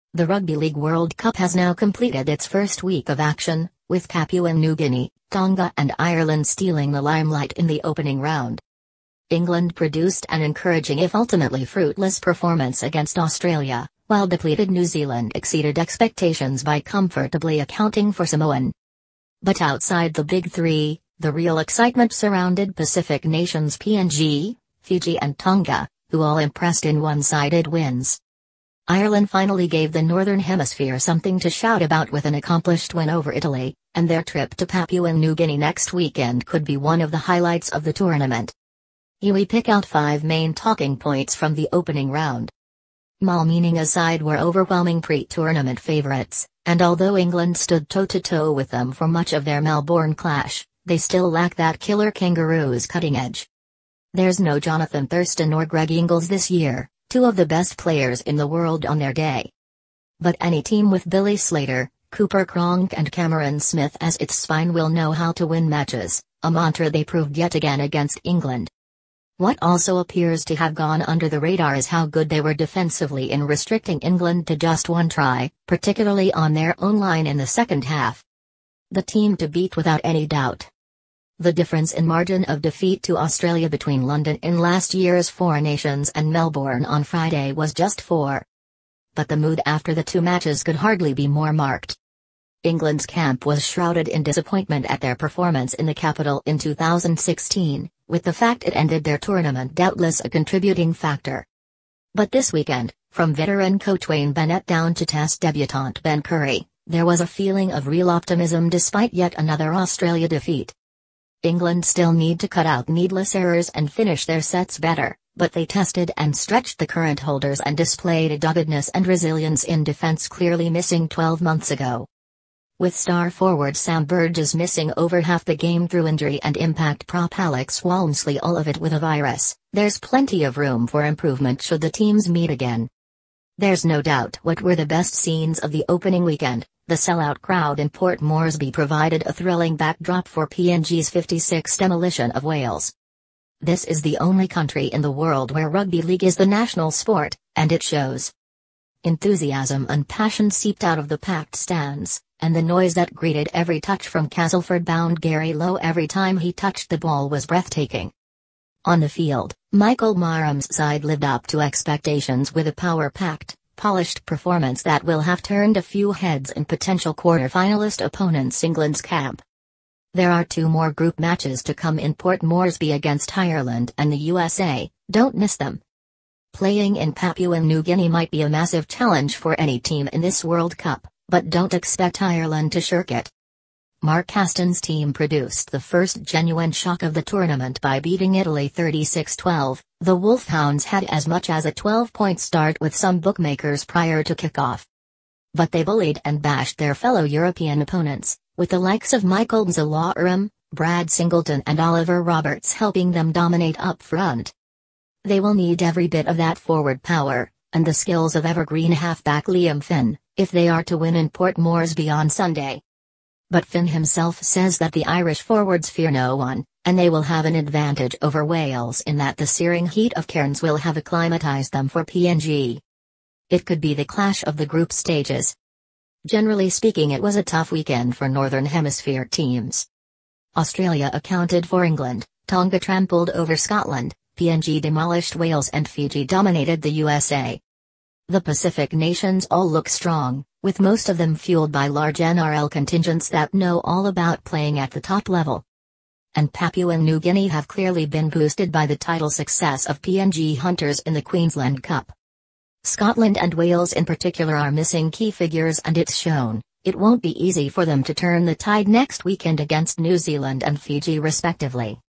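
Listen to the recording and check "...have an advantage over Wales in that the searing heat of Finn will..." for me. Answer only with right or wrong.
wrong.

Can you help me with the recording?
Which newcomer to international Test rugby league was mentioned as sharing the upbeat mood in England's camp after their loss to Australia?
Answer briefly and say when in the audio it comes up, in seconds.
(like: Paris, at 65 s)
Ben Currie, at 106 s.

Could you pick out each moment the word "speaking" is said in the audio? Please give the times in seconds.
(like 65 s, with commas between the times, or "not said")
226 s.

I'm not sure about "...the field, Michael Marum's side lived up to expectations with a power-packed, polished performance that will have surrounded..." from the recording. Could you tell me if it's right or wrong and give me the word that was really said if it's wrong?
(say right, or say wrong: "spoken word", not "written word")
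wrong: "turned", not "surrounded".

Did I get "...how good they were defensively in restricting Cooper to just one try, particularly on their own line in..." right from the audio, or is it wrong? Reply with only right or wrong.
wrong.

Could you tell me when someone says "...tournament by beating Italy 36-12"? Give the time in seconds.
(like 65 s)
187 s.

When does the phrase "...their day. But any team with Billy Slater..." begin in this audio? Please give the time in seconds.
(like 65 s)
58 s.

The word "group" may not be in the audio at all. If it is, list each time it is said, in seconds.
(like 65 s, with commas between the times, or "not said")
170 s, 224 s.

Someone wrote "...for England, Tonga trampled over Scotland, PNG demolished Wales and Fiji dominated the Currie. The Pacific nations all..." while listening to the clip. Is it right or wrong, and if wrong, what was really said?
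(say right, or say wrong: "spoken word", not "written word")
wrong: "USA", not "Currie".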